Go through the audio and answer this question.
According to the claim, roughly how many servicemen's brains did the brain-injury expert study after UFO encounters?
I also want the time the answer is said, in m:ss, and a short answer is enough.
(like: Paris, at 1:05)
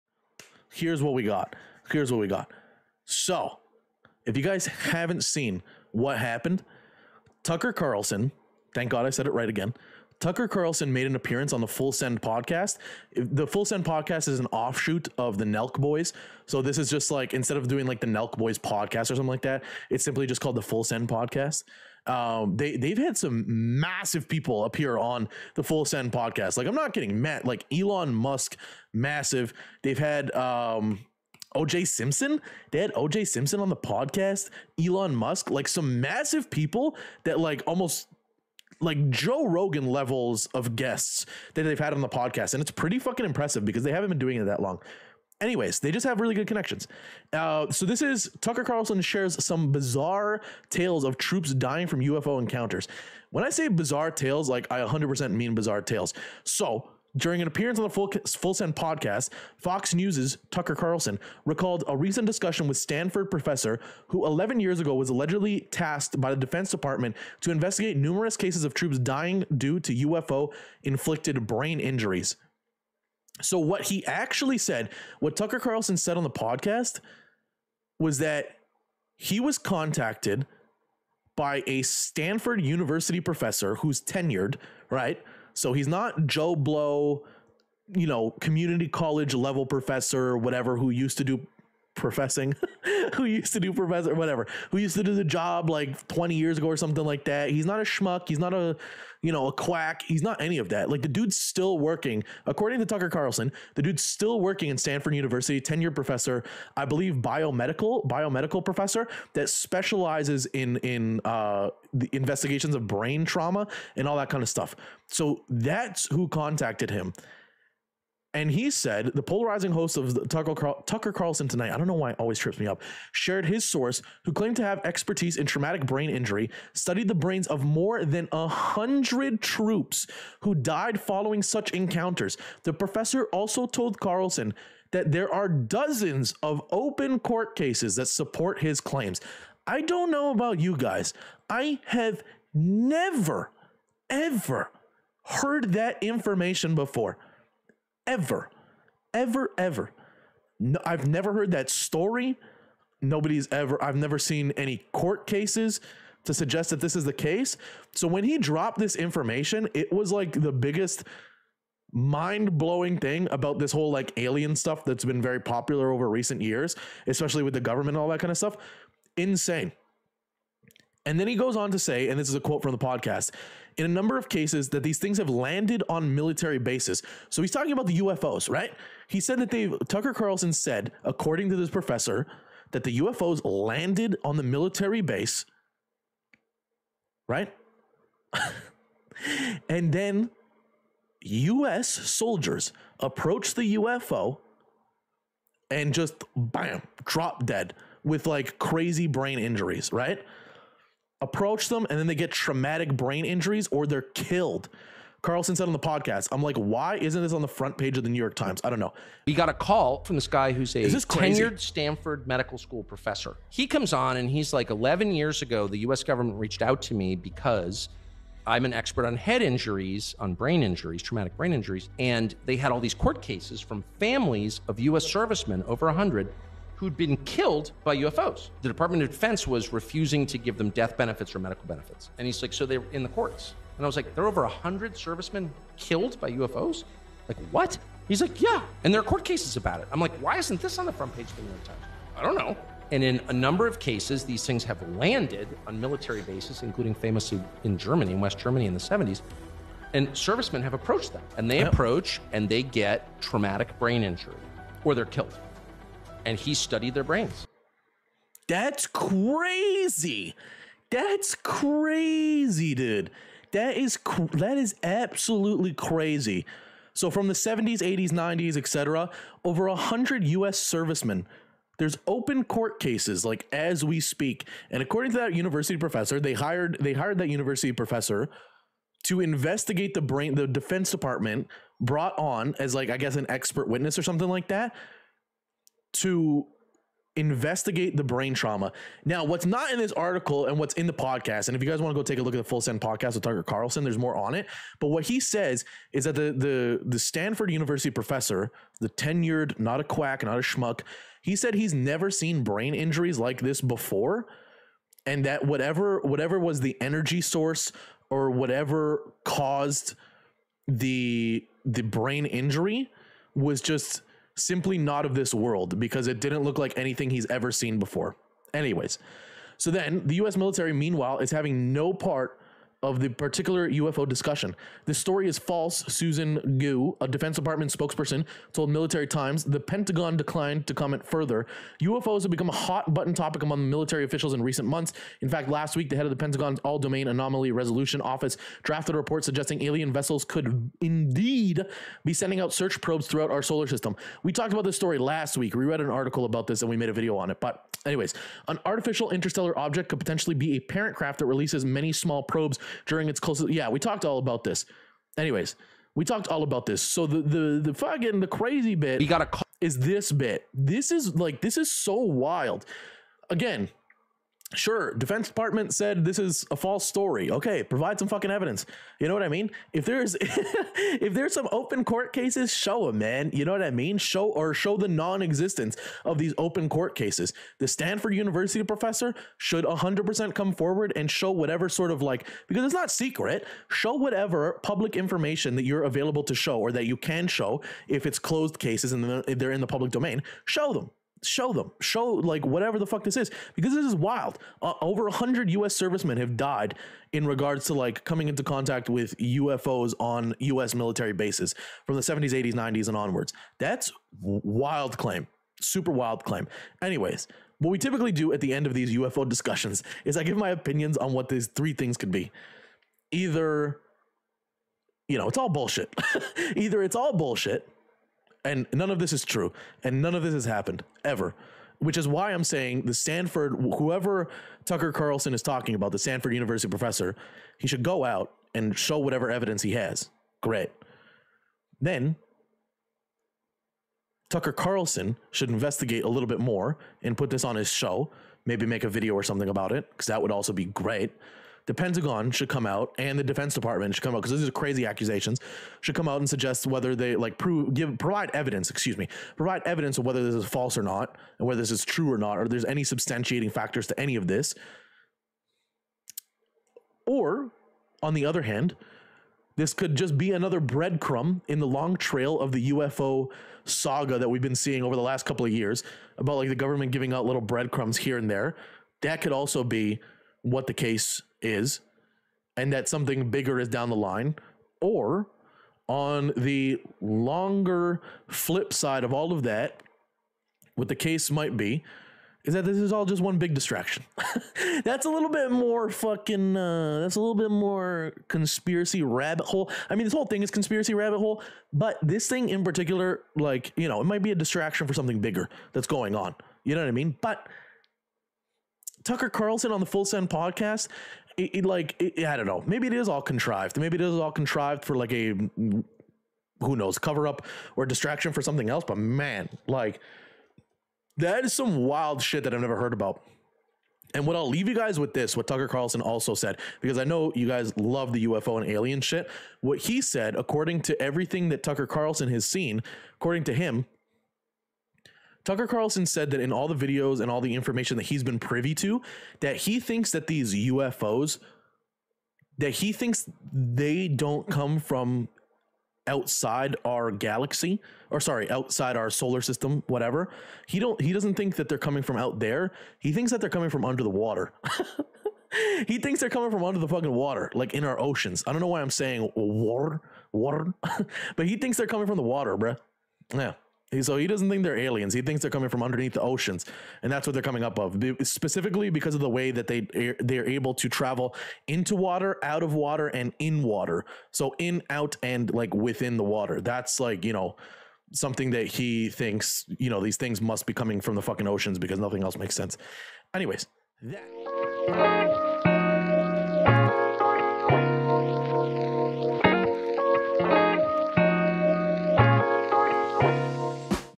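more than 100, at 2:07.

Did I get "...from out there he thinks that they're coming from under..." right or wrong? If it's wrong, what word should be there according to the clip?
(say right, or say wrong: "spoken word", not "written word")
right.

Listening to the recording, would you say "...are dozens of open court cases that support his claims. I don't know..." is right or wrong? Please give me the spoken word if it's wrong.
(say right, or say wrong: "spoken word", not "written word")
right.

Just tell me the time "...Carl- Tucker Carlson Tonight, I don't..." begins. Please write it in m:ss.
2:00.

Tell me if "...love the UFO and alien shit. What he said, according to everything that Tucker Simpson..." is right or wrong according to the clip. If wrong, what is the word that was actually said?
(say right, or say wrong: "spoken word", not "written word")
wrong: "Carlson", not "Simpson".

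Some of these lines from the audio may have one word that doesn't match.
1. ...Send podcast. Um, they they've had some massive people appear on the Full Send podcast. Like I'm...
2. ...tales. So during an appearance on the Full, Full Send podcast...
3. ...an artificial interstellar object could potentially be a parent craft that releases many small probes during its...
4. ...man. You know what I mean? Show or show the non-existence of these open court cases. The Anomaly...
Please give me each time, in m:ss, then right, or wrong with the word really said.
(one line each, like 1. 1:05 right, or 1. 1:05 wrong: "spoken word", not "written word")
1. 0:20 right
2. 0:55 right
3. 5:48 right
4. 6:12 wrong: "Stanford", not "Anomaly".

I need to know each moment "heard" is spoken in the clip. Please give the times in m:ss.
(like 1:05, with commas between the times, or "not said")
2:25, 2:31, 8:32.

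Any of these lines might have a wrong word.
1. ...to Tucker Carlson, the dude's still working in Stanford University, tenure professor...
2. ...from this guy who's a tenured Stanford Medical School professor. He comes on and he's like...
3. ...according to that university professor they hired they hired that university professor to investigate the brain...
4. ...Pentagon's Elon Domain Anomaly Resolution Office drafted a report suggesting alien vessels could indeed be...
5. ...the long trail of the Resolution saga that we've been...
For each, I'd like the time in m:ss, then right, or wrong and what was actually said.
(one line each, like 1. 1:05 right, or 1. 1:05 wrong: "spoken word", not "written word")
1. 1:42 right
2. 3:30 right
3. 4:34 right
4. 5:36 wrong: "All", not "Elon"
5. 7:41 wrong: "UFO", not "Resolution".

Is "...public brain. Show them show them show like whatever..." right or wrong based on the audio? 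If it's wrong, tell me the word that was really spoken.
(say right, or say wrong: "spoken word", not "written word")
wrong: "domain", not "brain".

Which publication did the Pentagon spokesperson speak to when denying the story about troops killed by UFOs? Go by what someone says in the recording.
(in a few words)
Military Times.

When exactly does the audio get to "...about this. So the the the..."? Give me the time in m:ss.
5:56.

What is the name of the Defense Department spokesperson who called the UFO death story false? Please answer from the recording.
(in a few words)
Susan Gu.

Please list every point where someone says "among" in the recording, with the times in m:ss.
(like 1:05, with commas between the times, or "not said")
5:33.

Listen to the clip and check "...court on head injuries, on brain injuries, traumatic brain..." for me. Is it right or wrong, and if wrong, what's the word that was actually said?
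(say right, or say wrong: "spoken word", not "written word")
wrong: "expert", not "court".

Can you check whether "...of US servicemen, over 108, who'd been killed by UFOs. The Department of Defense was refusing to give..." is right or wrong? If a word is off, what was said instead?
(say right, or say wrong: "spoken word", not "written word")
wrong: "100", not "108".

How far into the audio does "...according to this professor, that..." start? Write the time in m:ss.
3:01.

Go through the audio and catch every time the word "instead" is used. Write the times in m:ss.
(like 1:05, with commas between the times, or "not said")
0:17.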